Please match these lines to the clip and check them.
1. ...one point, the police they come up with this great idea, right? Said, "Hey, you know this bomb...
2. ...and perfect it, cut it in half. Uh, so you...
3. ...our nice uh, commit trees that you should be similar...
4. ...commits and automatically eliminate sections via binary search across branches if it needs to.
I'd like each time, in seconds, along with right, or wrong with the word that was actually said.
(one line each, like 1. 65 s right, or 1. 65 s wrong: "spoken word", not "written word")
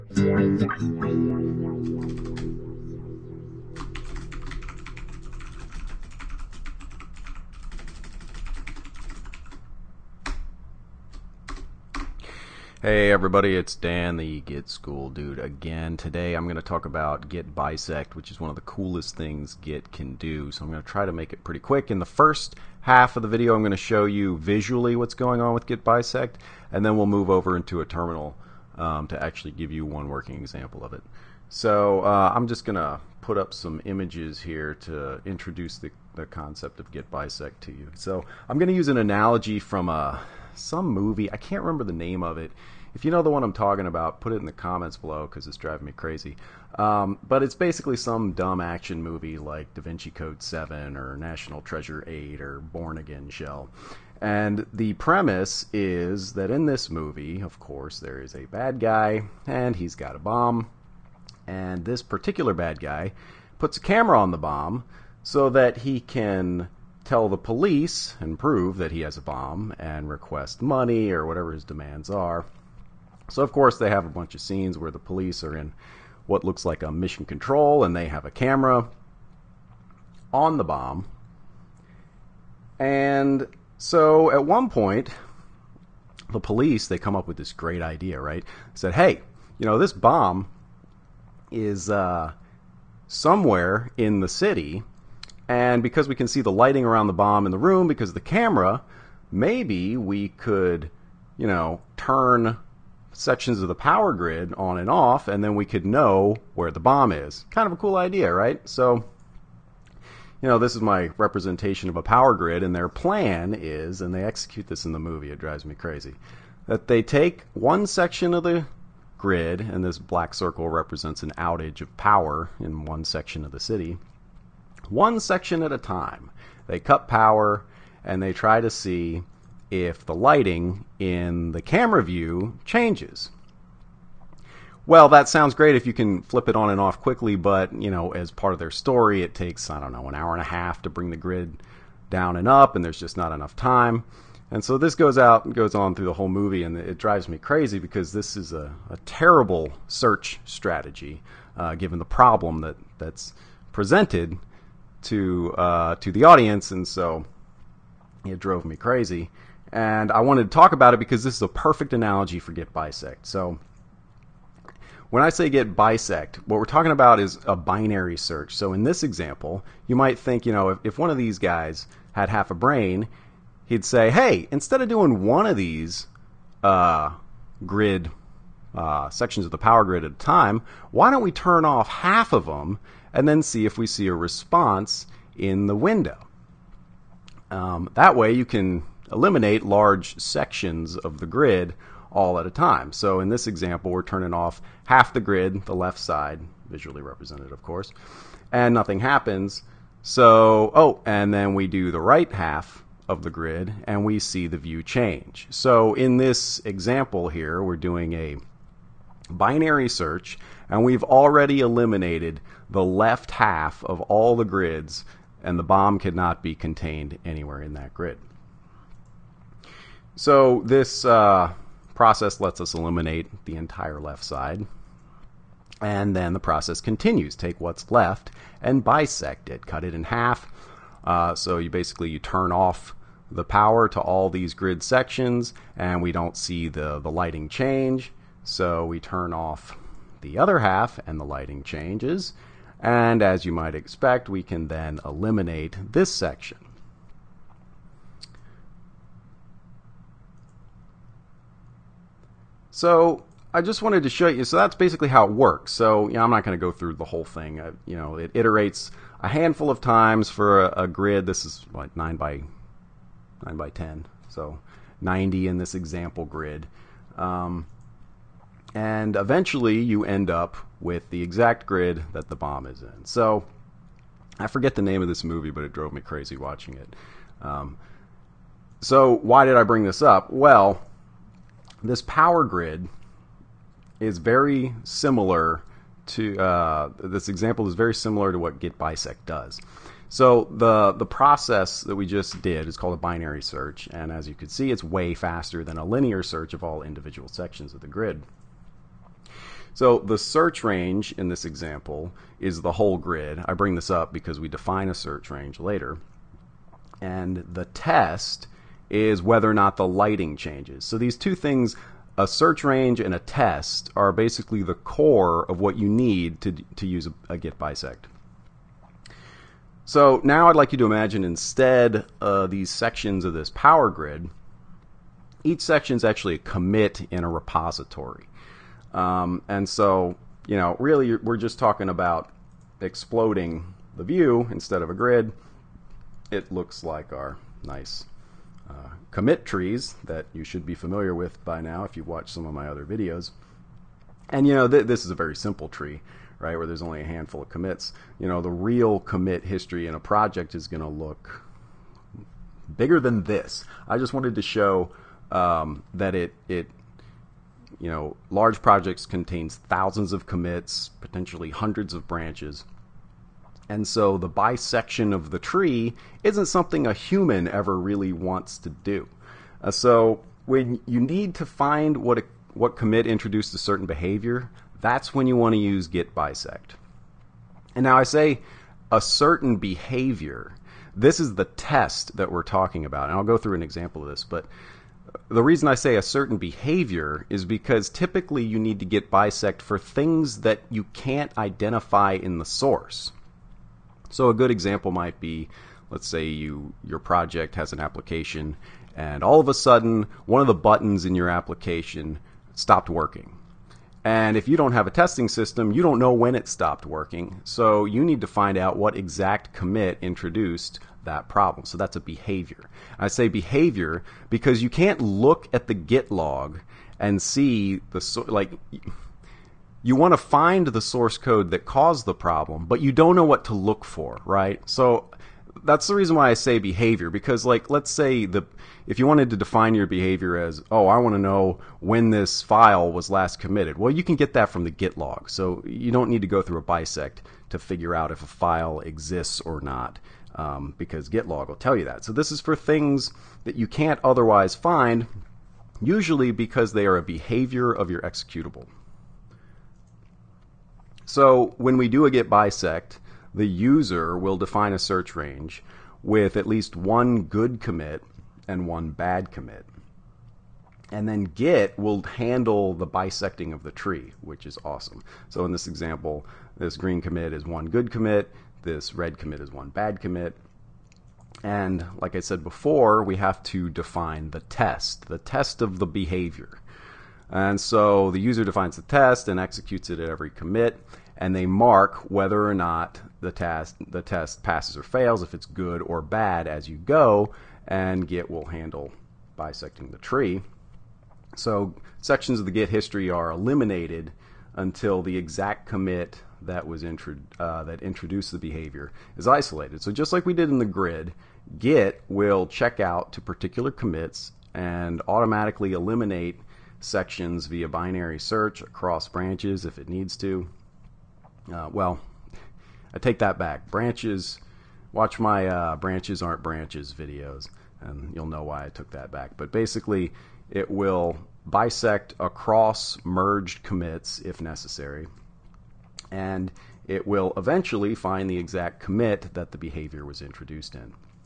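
1. 84 s right
2. 228 s wrong: "bisect", not "perfect"
3. 337 s wrong: "familiar", not "similar"
4. 503 s right.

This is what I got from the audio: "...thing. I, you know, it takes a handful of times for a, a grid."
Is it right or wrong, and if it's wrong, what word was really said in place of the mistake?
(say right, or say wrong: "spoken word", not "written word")
wrong: "iterates", not "takes".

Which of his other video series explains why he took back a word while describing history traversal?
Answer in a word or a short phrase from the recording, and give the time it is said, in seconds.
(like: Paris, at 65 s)
Branches Aren't Branches, at 515 s.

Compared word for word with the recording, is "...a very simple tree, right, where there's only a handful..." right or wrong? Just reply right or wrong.
right.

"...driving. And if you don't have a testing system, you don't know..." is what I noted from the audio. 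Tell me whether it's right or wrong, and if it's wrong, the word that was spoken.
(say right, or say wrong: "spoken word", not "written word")
wrong: "working", not "driving".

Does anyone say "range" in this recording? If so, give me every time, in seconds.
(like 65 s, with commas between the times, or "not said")
300 s, 305 s, 312 s, 455 s.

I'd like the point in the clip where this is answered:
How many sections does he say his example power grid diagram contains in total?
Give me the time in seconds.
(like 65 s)
265 s.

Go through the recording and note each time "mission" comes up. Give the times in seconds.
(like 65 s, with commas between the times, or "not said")
76 s.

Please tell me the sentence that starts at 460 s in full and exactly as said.
And then git will handle the bisecting of the tree, which is awesome.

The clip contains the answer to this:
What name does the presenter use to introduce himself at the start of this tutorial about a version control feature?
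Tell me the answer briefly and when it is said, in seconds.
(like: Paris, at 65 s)
Dan the Git School Dude, at 13 s.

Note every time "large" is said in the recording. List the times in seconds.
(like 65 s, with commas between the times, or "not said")
189 s, 358 s.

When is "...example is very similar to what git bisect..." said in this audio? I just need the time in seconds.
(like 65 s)
287 s.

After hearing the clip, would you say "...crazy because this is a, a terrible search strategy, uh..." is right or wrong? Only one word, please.
right.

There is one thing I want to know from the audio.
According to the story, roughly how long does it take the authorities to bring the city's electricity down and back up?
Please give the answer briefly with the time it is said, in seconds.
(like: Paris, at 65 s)
An hour and a half, at 140 s.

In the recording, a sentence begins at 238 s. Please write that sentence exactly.
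So we turn off the other half, and the lighting changes.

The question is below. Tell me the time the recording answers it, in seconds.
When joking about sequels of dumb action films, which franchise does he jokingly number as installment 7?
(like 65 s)
49 s.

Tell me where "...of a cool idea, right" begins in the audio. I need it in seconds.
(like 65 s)
107 s.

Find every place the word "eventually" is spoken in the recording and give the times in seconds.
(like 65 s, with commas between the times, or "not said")
269 s, 527 s.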